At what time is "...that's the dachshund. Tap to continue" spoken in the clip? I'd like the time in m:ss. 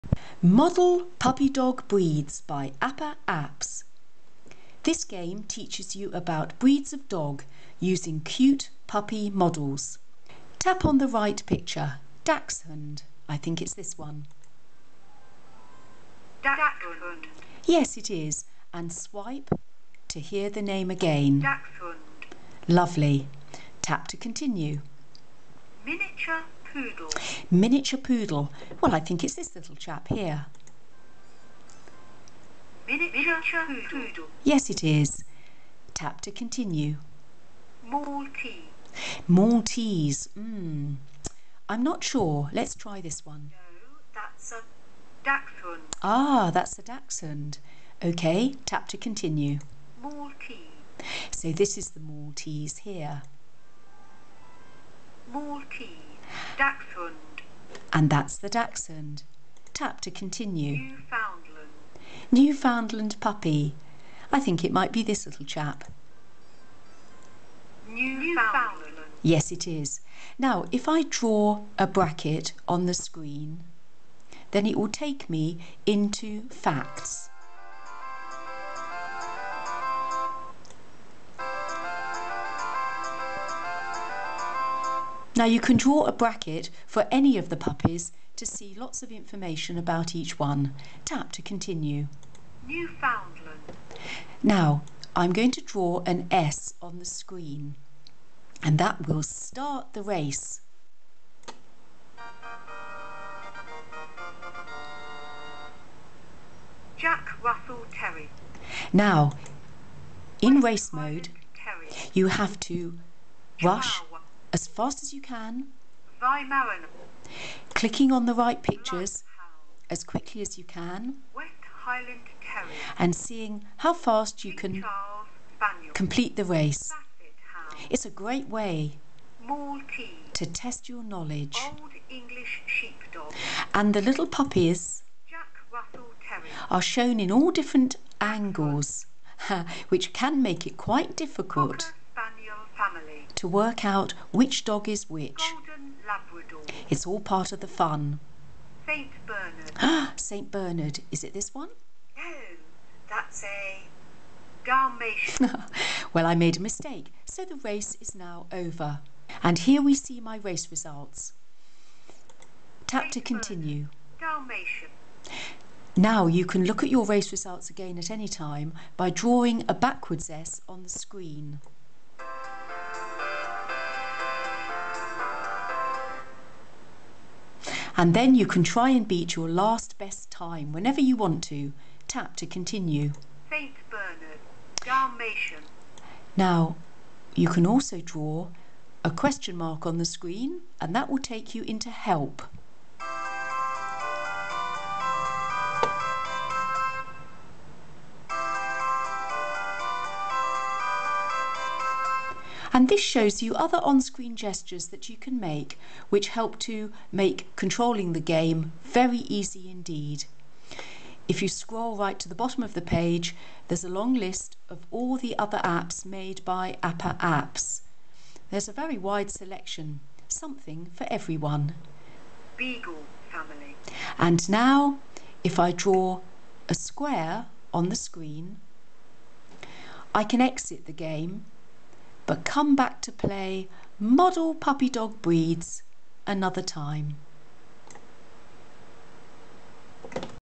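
0:58.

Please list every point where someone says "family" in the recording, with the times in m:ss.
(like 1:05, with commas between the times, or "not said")
2:22, 3:43.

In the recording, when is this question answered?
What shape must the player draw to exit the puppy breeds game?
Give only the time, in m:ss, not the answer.
3:46.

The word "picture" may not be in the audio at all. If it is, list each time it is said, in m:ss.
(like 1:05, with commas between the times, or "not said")
0:11, 1:58.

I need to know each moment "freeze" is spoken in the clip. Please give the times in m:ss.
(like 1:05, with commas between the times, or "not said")
not said.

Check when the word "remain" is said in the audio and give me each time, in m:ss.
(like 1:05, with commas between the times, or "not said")
not said.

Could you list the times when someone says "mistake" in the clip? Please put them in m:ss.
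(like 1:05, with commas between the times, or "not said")
2:36.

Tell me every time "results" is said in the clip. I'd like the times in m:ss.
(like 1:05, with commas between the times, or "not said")
2:40, 2:47.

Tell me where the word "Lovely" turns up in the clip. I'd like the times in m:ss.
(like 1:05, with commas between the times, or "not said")
0:22.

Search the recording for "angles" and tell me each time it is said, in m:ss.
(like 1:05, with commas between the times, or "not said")
2:18.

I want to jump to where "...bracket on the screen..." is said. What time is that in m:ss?
1:11.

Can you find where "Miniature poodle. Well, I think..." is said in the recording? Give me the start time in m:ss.
0:27.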